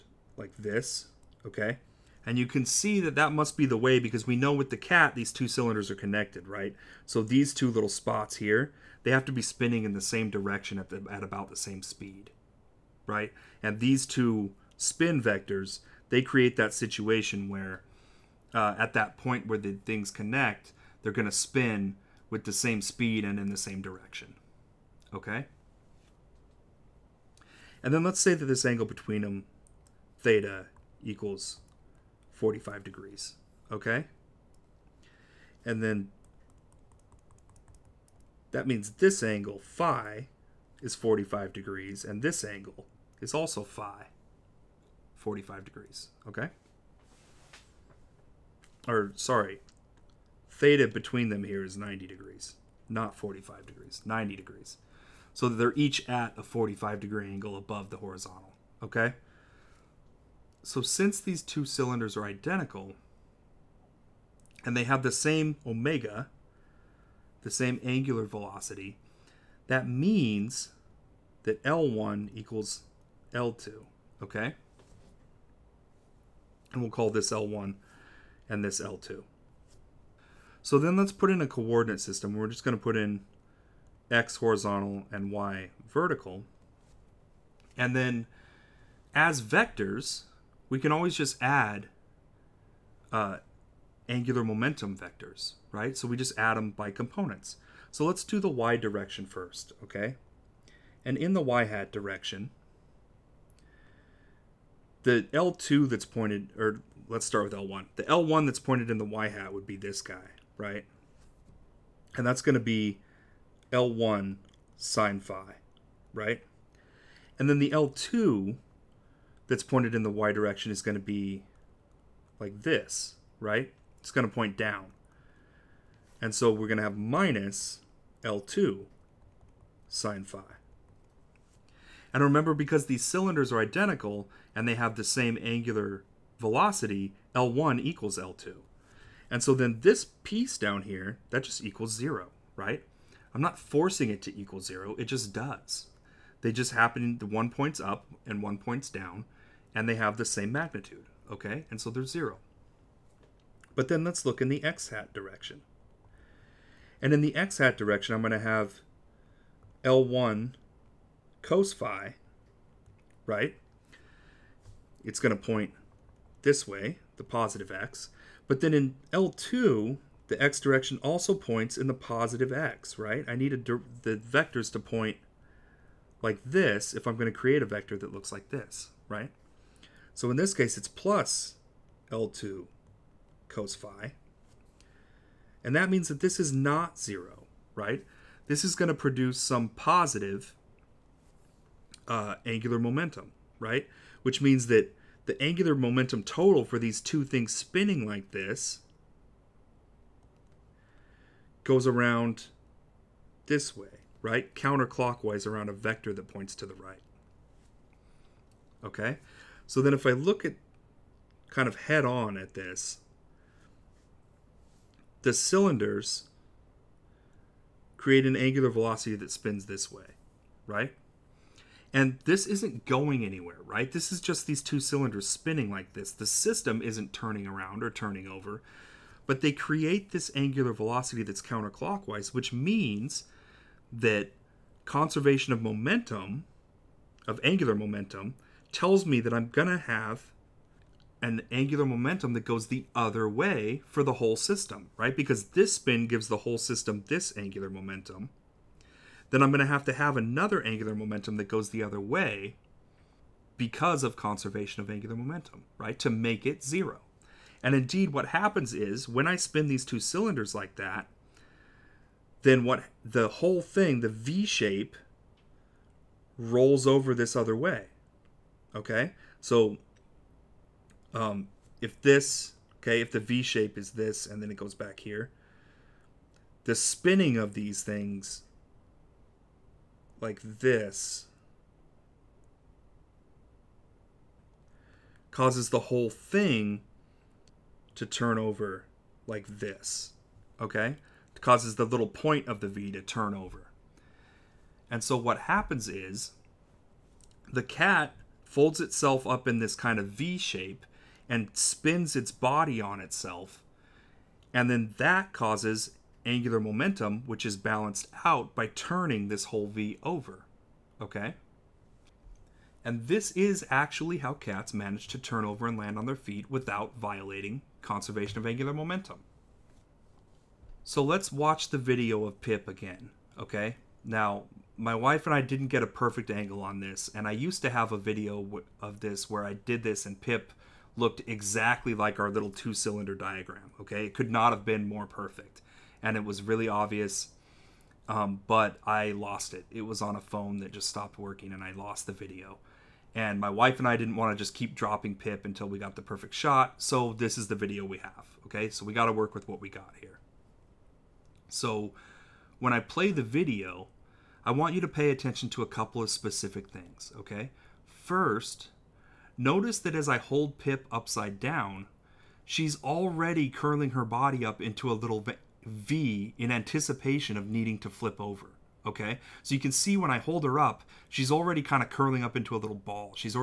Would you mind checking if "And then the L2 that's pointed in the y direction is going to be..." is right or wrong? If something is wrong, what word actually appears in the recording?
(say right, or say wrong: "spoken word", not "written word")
right.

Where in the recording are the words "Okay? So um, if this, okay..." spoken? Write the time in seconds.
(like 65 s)
268 s.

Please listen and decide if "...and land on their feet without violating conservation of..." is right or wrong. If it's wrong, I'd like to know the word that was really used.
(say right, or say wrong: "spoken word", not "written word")
right.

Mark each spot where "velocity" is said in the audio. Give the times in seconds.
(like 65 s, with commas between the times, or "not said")
68 s, 136 s, 218 s, 230 s.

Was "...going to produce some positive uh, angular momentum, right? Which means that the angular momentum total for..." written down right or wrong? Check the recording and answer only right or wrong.
right.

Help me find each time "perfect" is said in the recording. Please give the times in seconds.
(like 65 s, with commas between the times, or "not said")
325 s, 335 s, 346 s.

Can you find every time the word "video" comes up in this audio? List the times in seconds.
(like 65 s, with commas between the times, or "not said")
321 s, 327 s, 342 s, 347 s, 353 s.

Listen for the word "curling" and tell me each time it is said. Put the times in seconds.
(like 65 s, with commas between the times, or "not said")
363 s, 371 s.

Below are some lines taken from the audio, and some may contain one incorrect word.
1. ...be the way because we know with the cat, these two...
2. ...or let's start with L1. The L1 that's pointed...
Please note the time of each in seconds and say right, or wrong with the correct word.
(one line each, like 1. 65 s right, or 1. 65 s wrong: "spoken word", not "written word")
1. 3 s right
2. 106 s right.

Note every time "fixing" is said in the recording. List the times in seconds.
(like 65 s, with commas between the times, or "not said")
not said.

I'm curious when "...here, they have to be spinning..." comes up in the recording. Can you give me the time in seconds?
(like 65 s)
8 s.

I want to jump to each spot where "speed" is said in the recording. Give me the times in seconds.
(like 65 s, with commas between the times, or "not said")
11 s, 22 s.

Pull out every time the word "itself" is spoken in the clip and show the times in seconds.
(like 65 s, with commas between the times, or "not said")
298 s, 302 s.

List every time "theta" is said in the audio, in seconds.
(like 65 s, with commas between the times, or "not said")
30 s, 50 s.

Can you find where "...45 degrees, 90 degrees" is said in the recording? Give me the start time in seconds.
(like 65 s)
53 s.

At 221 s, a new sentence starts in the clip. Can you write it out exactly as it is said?
And this isn't going anywhere, right?